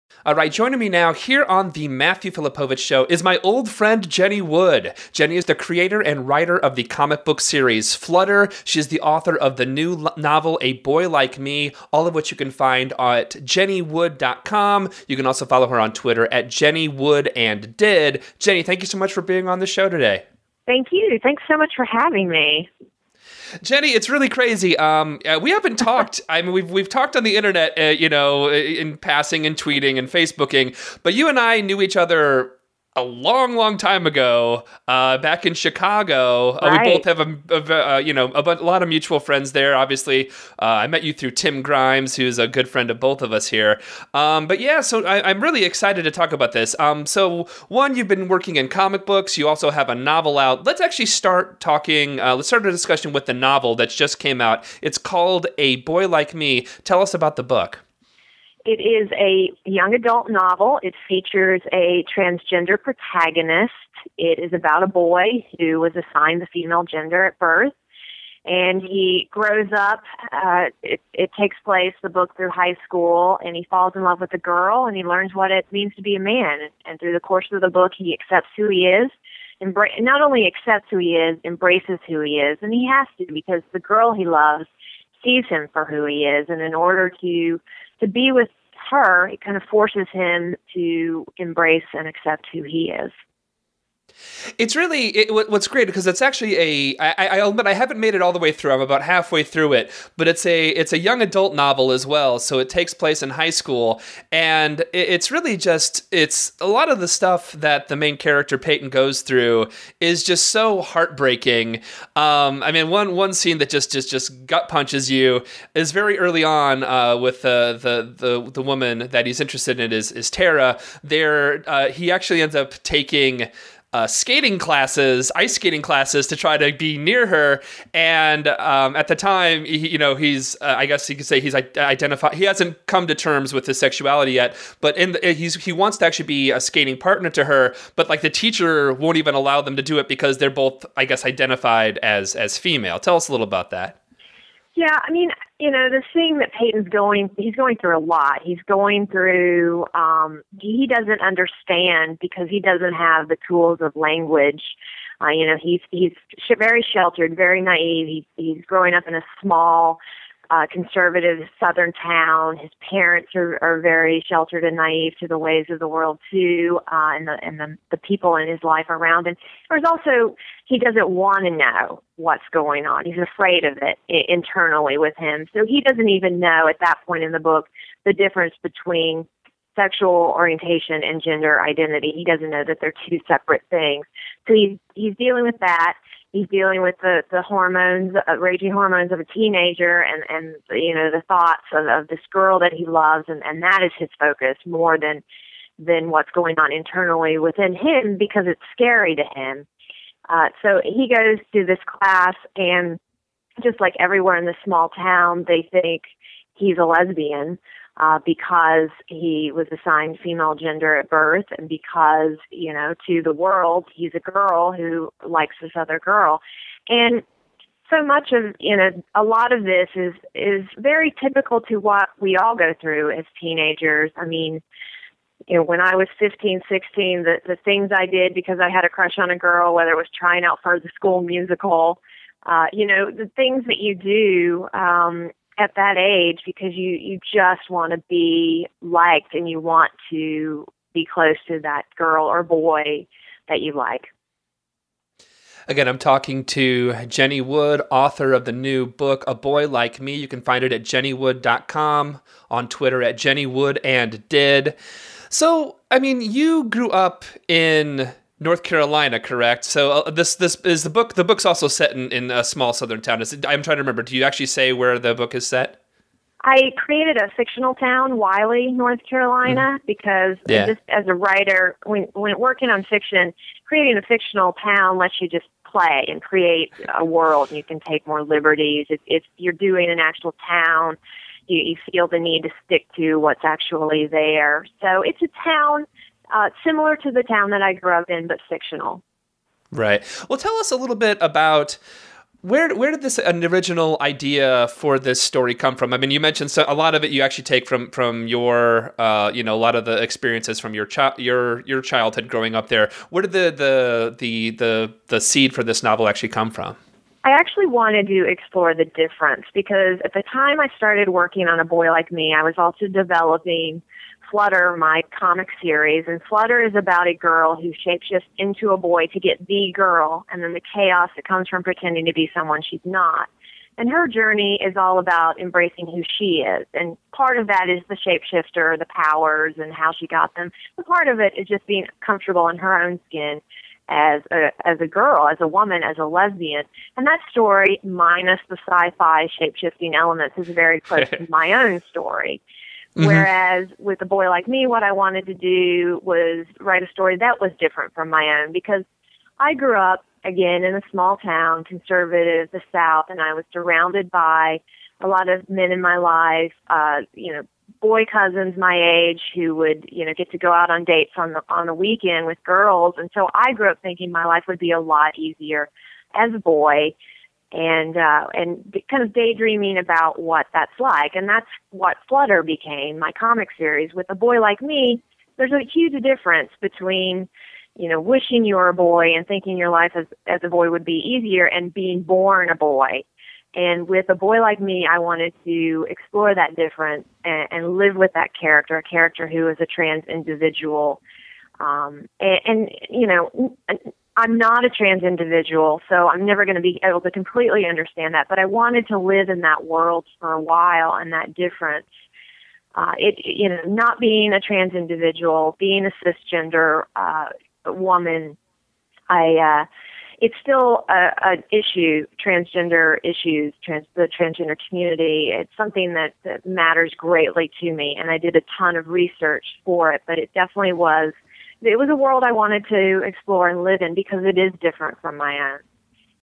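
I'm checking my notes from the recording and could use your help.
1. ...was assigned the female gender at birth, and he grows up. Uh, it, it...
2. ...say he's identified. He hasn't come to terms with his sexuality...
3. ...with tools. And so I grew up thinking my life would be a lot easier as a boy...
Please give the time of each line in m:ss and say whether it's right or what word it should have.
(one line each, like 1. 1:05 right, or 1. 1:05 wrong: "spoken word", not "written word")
1. 1:05 right
2. 2:11 right
3. 6:02 wrong: "girls", not "tools".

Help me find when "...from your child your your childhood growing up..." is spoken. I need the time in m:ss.
5:00.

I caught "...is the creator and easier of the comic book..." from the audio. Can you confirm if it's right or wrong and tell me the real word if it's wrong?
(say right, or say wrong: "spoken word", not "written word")
wrong: "writer", not "easier".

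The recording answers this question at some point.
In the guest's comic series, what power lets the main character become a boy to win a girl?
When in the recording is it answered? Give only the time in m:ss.
5:17.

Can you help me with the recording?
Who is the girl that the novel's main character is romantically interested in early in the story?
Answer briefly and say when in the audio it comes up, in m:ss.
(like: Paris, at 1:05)
Tara, at 2:00.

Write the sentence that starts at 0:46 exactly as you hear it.
Um, so one, you've been working in comic books.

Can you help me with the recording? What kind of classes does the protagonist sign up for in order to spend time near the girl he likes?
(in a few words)
ice skating classes.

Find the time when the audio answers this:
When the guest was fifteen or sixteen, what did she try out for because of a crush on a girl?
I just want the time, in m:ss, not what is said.
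3:50.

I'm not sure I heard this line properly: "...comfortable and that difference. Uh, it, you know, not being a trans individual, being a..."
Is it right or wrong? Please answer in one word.
wrong.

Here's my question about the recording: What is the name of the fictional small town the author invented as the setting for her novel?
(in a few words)
Wiley.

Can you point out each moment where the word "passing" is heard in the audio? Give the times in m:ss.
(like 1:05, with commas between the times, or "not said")
0:28.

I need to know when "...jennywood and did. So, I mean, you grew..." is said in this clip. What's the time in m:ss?
4:13.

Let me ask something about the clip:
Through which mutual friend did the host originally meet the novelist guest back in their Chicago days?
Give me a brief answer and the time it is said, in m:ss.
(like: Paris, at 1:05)
Tim Grimes, at 0:41.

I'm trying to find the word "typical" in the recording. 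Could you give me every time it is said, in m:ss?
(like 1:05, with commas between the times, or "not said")
3:41.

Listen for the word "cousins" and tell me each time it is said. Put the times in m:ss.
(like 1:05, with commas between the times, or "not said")
5:58.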